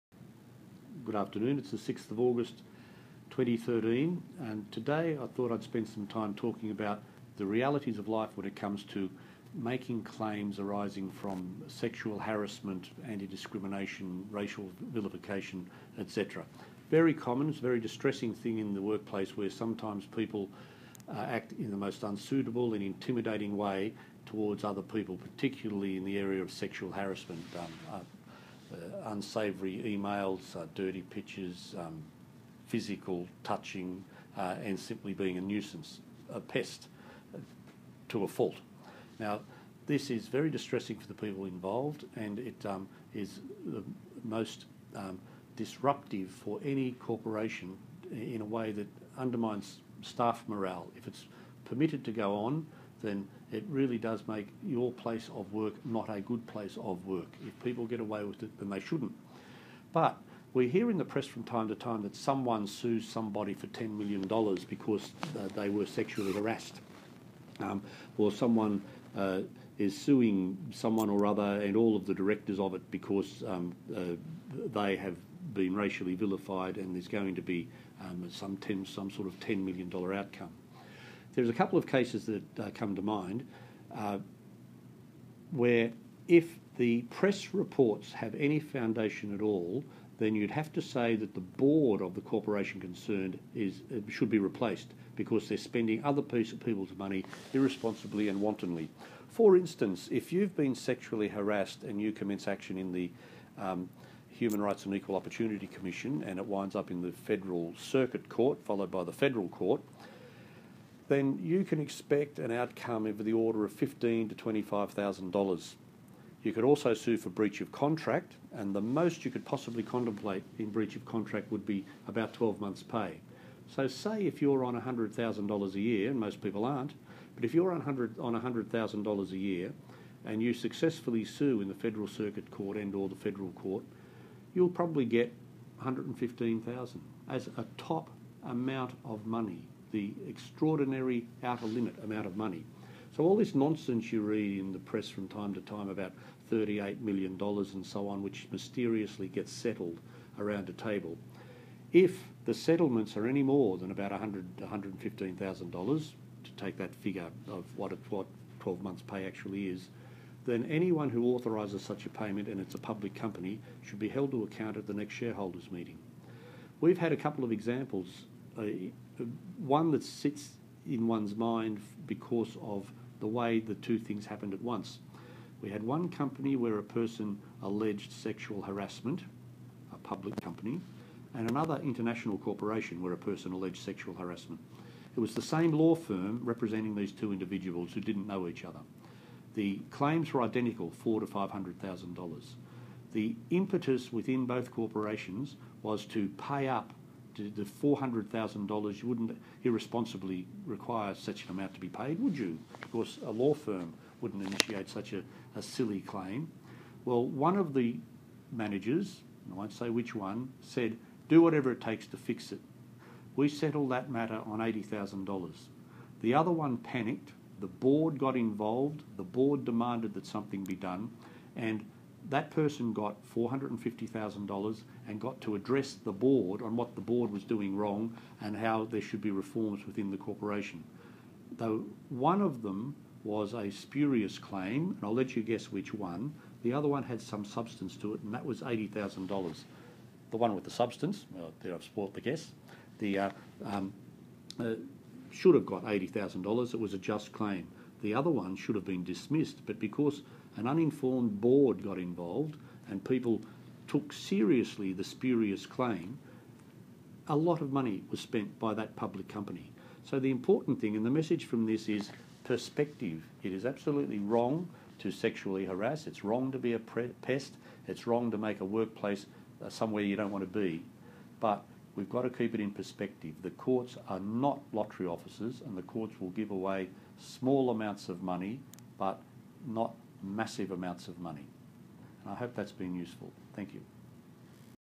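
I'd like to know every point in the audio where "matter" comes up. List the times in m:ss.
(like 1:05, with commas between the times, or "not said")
3:34.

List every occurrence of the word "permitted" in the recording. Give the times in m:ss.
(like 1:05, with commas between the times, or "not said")
0:51.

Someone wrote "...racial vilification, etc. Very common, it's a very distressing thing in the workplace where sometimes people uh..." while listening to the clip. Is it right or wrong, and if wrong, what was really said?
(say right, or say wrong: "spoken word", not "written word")
right.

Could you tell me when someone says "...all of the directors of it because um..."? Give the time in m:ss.
1:11.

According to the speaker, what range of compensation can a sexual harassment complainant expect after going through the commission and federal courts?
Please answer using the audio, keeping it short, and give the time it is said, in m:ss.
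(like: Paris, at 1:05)
$15,000 to $25,000, at 1:53.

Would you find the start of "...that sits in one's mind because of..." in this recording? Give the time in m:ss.
2:49.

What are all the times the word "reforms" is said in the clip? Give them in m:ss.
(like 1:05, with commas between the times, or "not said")
3:49.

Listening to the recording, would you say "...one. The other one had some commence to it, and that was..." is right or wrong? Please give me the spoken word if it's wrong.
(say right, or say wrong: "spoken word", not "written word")
wrong: "substance", not "commence".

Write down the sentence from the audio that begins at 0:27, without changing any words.
Um, uh, uh, unsavoury emails, uh, dirty pictures, um, physical touching, uh, and simply being a nuisance, a pest to a fault.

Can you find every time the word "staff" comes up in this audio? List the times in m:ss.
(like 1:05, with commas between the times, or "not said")
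0:50.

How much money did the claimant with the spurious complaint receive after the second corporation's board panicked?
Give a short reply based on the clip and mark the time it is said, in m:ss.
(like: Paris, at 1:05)
$450,000, at 3:43.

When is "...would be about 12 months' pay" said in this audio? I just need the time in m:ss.
2:01.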